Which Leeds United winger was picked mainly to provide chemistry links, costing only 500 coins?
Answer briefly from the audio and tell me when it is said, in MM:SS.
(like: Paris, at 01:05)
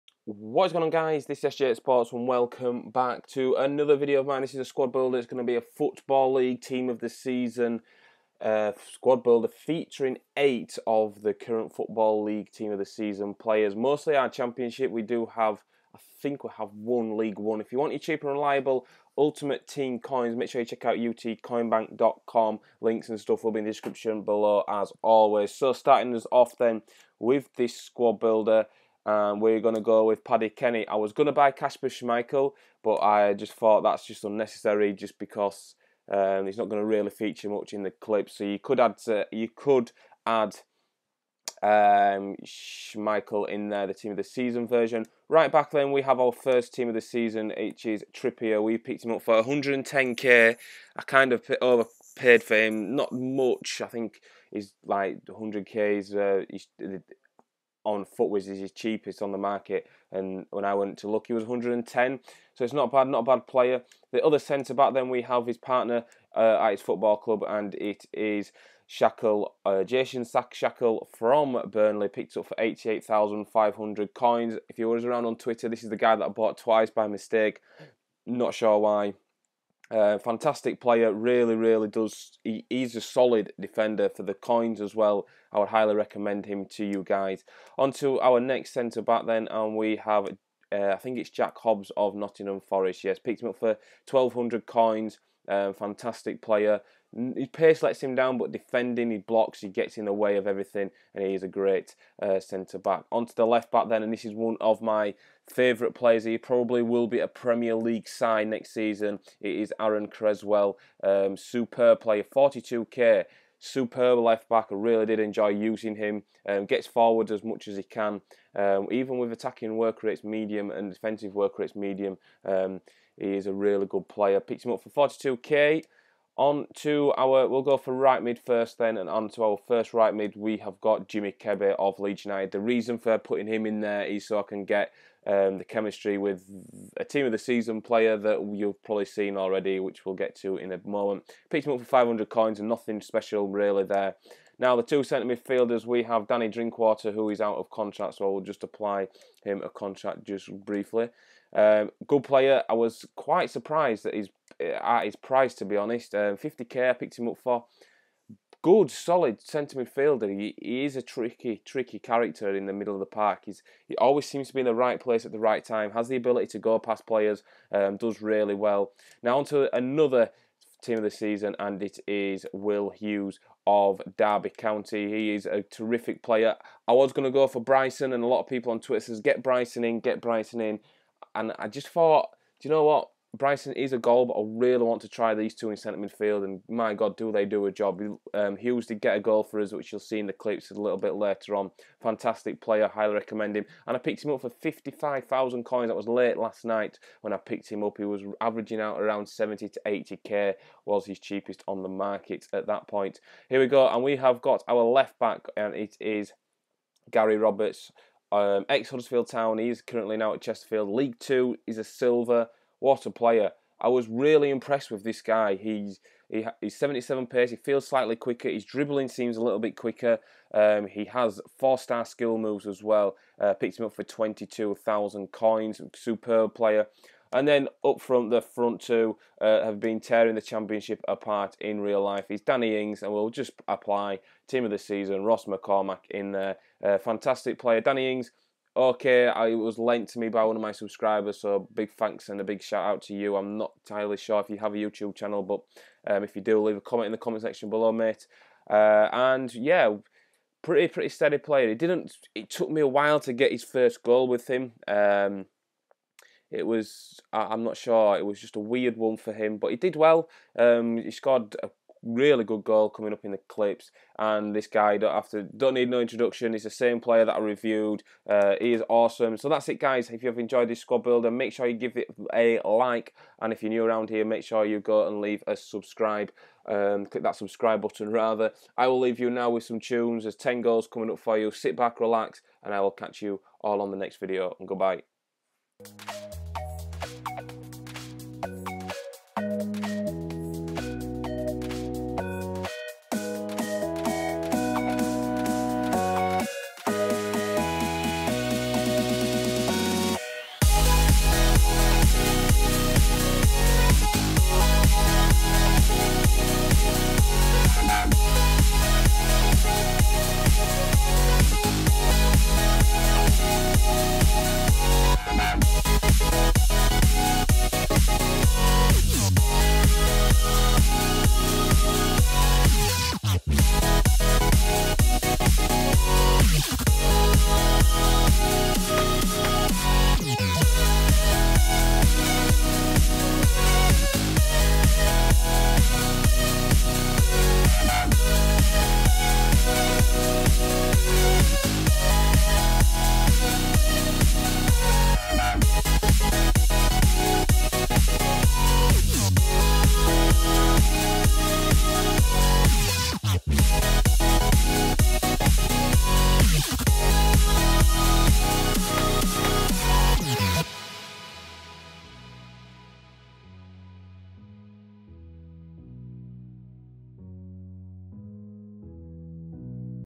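Jimmy Kebe, at 02:11.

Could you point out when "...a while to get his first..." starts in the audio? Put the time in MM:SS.
04:12.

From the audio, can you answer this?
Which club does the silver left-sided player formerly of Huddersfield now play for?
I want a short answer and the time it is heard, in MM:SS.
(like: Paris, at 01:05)
Chesterfield, at 03:30.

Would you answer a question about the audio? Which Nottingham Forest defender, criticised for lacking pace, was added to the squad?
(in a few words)
Jack Hobbs.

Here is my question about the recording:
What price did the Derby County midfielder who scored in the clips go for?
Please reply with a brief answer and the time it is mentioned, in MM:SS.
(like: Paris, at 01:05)
55,000 coins, at 03:14.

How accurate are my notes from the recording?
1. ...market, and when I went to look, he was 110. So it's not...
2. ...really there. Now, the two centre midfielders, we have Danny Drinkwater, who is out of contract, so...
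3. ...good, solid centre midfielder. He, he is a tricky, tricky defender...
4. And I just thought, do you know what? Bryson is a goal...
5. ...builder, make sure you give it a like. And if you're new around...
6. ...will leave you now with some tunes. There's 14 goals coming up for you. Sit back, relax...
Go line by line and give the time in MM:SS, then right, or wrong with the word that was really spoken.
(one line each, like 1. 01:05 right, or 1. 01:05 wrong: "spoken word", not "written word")
1. 00:59 right
2. 02:23 right
3. 02:38 wrong: "character", not "defender"
4. 03:01 right
5. 04:31 right
6. 04:38 wrong: "10", not "14".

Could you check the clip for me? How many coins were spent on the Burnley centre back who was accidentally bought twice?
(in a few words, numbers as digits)
88,500.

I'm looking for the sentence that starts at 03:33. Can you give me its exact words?
I was really impressed with this guy.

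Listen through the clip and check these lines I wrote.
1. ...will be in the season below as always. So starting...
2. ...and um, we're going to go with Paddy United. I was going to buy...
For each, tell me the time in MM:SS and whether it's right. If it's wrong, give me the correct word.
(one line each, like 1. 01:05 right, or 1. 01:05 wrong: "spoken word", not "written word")
1. 00:23 wrong: "description", not "season"
2. 00:29 wrong: "Kenny", not "United".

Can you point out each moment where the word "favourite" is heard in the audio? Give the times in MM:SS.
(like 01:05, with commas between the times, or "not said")
01:45.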